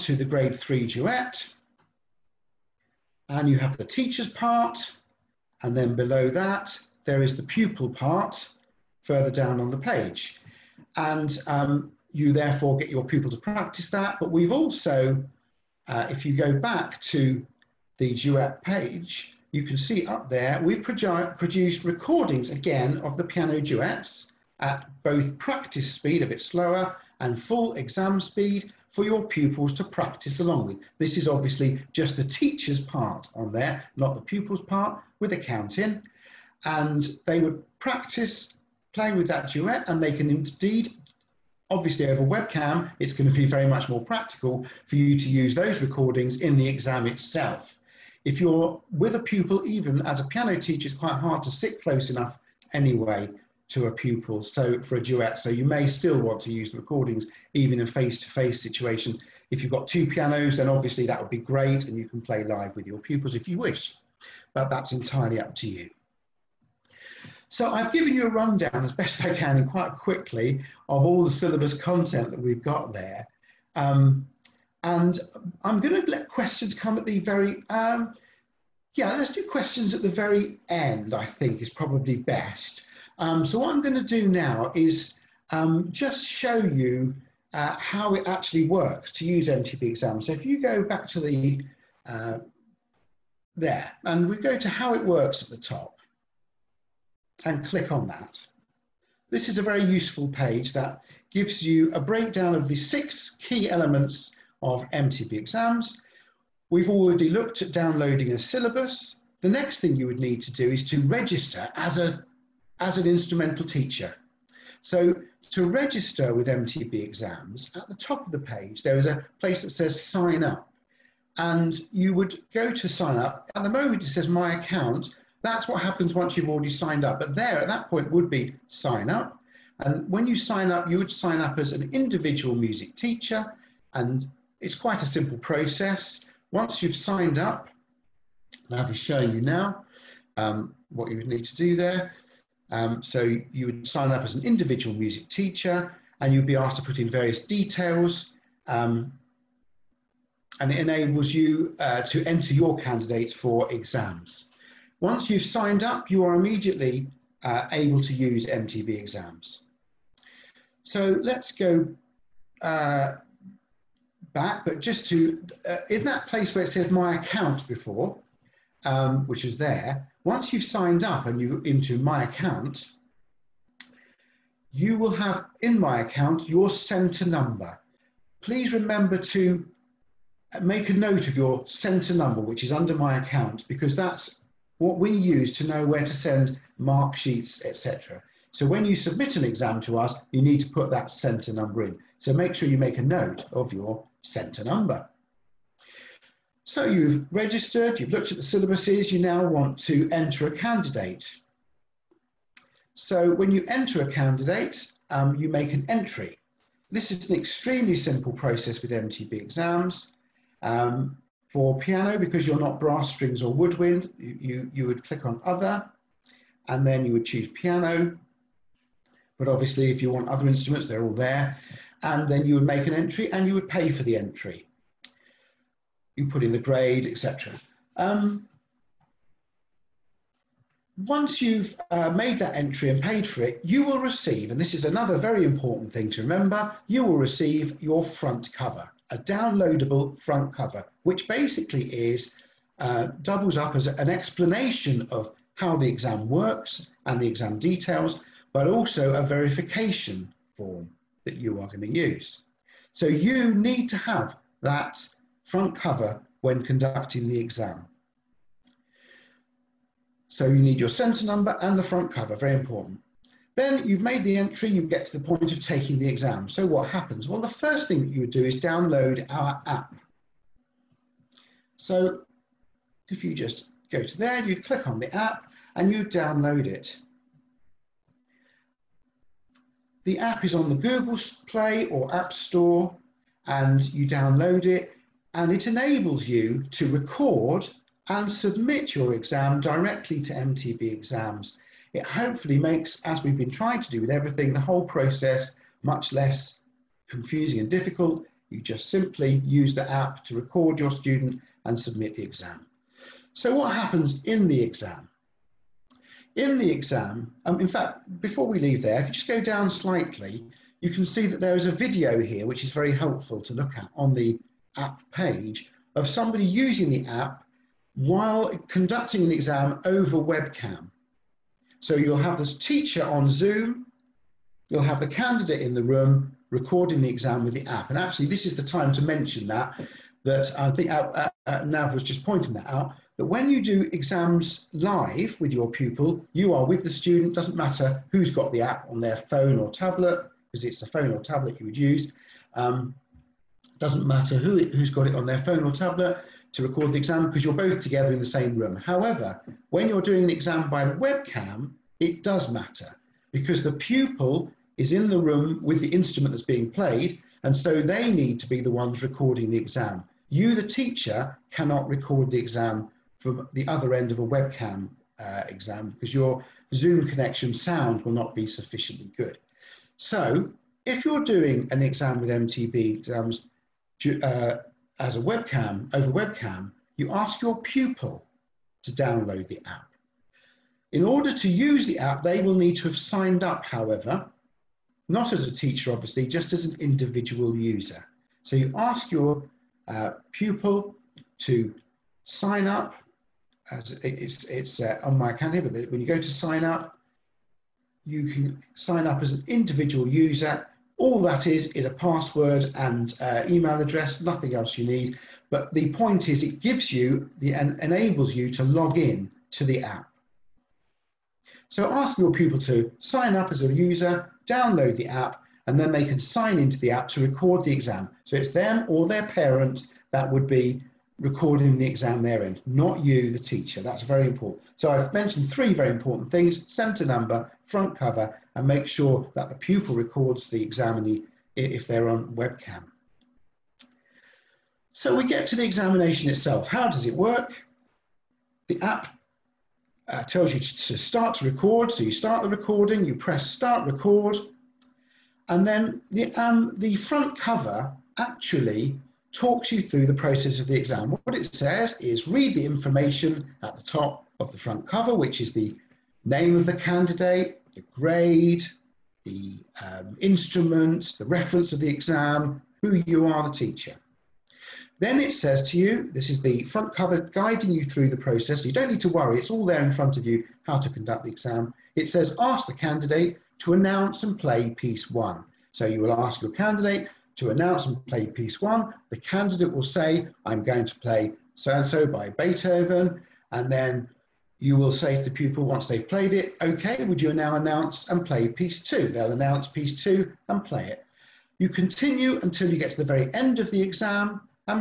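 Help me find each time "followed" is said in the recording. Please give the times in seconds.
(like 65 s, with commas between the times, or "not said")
not said.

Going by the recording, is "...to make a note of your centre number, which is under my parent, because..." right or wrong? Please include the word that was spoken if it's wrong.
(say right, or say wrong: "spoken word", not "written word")
wrong: "account", not "parent".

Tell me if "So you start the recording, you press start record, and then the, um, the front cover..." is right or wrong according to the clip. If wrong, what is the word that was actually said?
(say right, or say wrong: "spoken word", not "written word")
right.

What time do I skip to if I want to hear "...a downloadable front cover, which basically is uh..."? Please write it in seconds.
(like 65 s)
239 s.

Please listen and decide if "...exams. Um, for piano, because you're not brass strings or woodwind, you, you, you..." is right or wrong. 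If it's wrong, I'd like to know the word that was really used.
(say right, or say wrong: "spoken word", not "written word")
right.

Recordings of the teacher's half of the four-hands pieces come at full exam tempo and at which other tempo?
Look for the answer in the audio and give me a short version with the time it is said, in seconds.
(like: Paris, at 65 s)
practice speed, at 25 s.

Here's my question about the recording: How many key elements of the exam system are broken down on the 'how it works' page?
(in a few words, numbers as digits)
6.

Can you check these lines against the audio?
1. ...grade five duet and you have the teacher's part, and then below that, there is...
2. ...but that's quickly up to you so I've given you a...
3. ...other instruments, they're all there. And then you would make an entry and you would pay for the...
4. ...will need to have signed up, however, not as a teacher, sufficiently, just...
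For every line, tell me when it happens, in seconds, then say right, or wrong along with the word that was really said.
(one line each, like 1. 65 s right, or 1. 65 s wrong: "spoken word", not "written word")
1. 0 s wrong: "three", not "five"
2. 64 s wrong: "entirely", not "quickly"
3. 220 s right
4. 382 s wrong: "obviously", not "sufficiently".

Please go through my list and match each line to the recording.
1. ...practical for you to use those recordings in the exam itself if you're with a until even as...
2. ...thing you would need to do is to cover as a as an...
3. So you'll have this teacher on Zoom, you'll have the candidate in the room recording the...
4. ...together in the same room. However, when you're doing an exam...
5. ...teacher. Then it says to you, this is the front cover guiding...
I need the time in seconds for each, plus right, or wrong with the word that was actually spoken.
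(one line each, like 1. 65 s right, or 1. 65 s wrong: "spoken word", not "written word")
1. 44 s wrong: "pupil", not "until"
2. 109 s wrong: "register", not "cover"
3. 321 s right
4. 347 s right
5. 463 s right.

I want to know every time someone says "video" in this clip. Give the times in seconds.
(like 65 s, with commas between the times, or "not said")
311 s.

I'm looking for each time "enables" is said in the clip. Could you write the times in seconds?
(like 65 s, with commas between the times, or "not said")
150 s, 285 s, 407 s.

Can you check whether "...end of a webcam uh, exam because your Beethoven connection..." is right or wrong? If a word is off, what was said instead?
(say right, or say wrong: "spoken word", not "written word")
wrong: "Zoom", not "Beethoven".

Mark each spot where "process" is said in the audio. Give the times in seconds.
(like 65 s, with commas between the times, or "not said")
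135 s, 208 s, 294 s, 450 s, 468 s.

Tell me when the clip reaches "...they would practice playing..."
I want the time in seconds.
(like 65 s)
37 s.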